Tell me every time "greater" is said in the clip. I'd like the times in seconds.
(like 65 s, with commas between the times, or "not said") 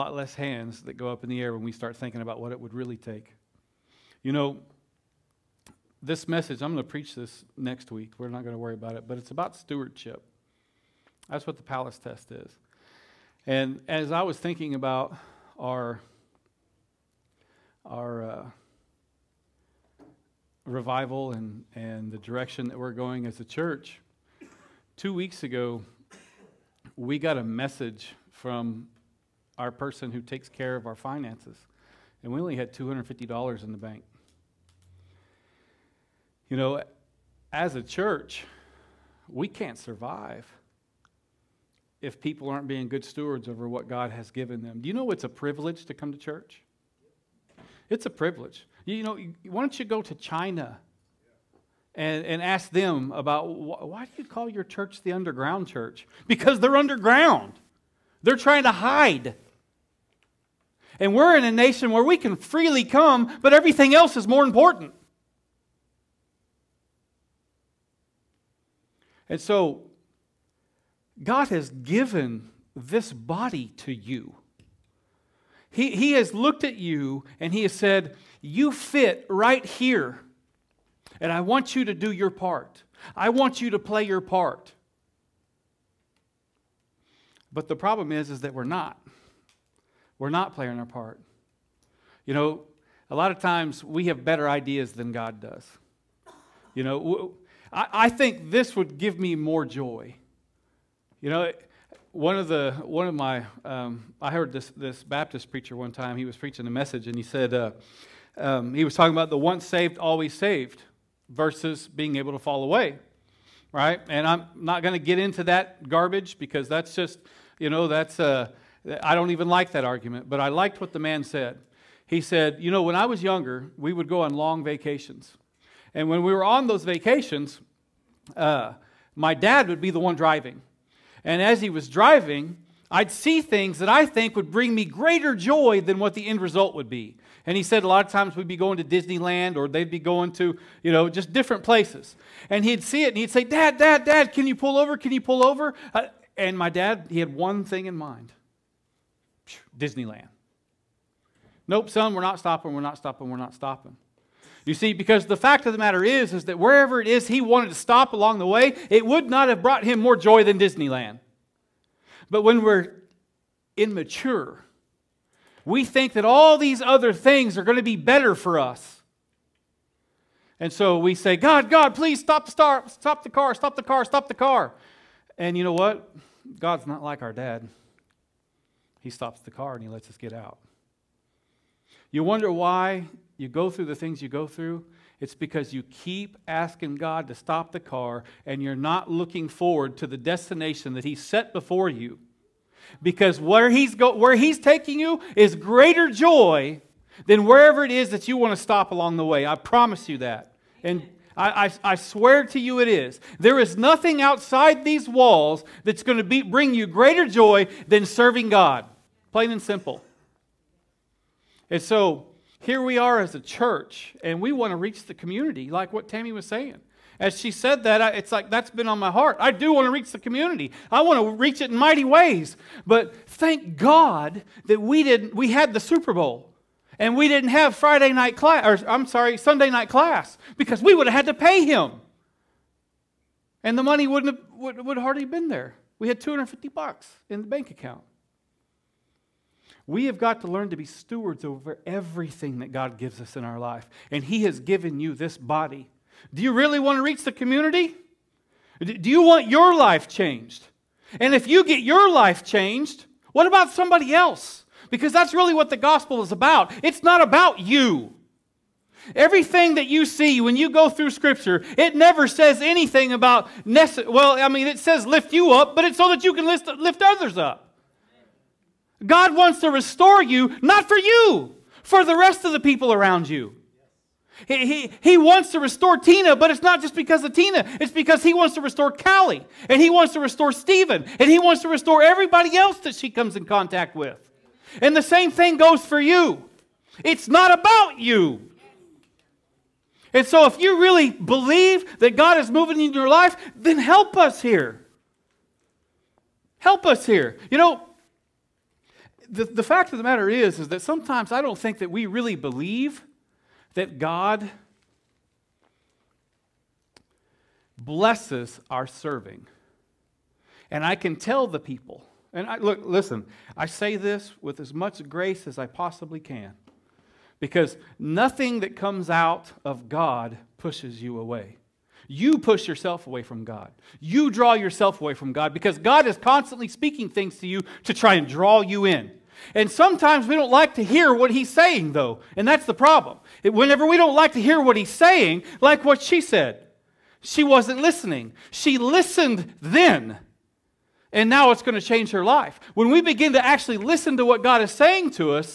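134 s, 195 s, 206 s.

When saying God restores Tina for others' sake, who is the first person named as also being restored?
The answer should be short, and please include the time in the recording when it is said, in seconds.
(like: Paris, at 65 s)
Callie, at 278 s.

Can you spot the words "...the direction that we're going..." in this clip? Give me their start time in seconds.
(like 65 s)
22 s.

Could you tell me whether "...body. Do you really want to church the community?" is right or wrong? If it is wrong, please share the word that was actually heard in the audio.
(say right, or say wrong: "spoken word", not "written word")
wrong: "reach", not "church".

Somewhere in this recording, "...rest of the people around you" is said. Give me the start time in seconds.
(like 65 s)
272 s.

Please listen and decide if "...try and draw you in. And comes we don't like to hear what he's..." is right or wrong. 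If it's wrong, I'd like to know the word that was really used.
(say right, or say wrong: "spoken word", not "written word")
wrong: "sometimes", not "comes".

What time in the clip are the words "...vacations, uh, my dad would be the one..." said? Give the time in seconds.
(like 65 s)
126 s.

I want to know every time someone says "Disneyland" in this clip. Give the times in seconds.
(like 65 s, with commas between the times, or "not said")
138 s, 149 s, 160 s.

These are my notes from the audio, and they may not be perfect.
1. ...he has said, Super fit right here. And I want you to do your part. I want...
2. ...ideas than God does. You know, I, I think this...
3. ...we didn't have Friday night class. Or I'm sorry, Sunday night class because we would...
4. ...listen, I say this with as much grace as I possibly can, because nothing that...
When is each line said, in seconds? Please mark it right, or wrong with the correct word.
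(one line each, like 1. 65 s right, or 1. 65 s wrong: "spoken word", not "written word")
1. 77 s wrong: "You", not "Super"
2. 94 s right
3. 227 s right
4. 312 s right.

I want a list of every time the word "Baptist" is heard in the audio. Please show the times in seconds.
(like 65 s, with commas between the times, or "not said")
105 s.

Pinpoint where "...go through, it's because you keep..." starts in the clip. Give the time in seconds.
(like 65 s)
184 s.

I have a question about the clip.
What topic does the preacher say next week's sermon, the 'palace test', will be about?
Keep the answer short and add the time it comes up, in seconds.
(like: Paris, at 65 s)
Stewardship, at 9 s.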